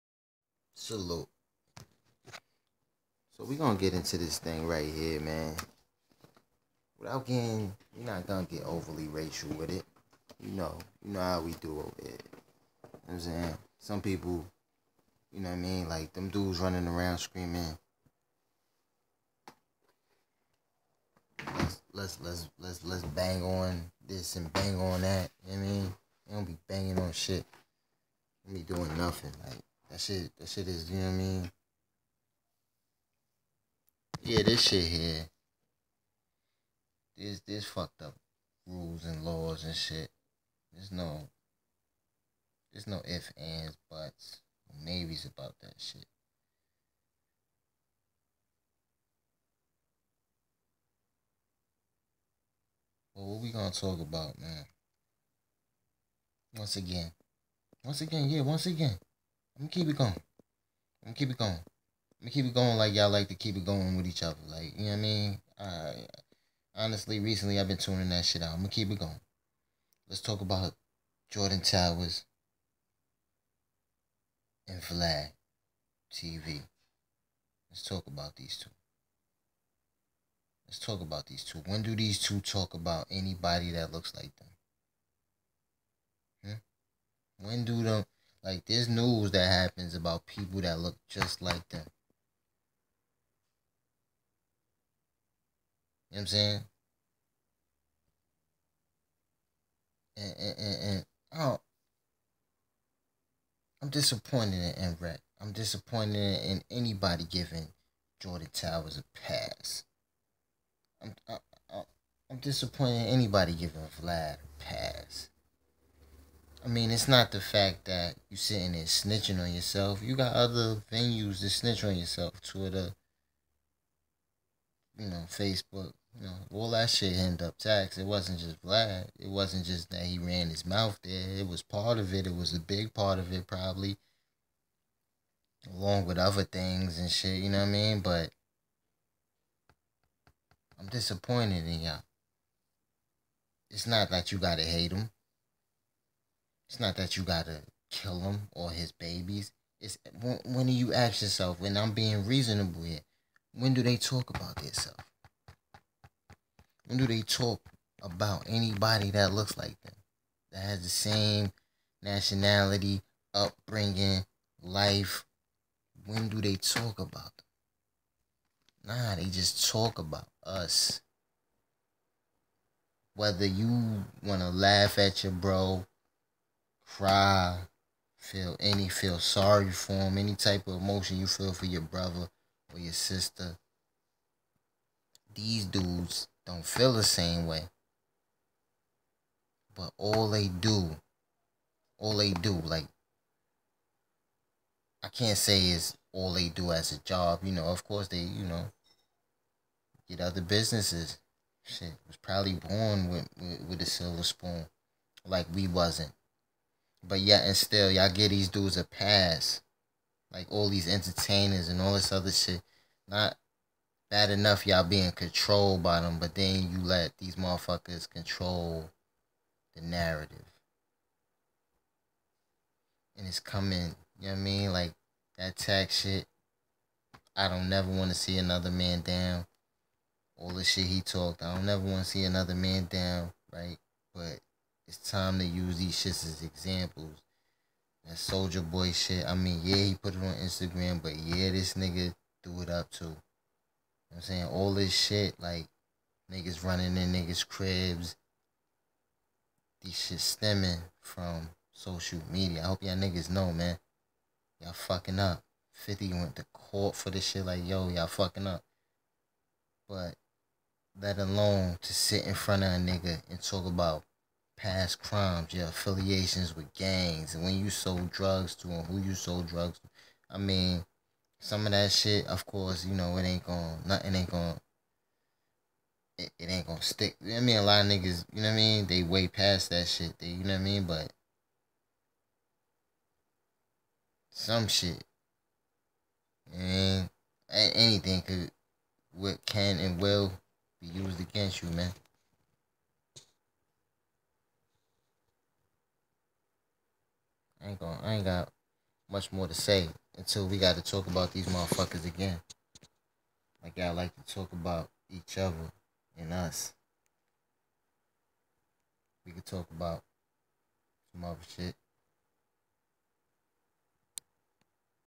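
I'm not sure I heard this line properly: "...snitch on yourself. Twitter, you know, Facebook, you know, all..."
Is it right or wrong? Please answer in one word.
right.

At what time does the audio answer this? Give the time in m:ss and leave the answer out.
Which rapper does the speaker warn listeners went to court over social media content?
4:15.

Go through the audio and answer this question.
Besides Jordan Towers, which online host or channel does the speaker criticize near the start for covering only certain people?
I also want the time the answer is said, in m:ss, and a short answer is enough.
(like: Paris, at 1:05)
Flag TV, at 1:14.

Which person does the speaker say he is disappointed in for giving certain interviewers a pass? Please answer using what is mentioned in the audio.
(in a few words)
MReck.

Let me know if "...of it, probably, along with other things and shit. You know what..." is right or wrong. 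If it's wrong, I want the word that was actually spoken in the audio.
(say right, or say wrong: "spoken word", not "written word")
right.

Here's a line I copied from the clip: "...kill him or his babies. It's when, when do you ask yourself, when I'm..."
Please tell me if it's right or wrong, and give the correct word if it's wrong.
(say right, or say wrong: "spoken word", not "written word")
right.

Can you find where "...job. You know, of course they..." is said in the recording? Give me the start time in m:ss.
3:17.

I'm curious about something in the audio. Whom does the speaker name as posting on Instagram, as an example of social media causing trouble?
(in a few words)
Soldier Boy.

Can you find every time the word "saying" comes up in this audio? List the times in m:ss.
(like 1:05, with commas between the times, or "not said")
0:13, 1:36, 4:04.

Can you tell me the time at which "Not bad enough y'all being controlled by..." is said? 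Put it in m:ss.
3:33.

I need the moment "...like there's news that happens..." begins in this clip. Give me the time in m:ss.
1:28.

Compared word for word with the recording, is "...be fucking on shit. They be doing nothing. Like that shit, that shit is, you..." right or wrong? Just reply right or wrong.
wrong.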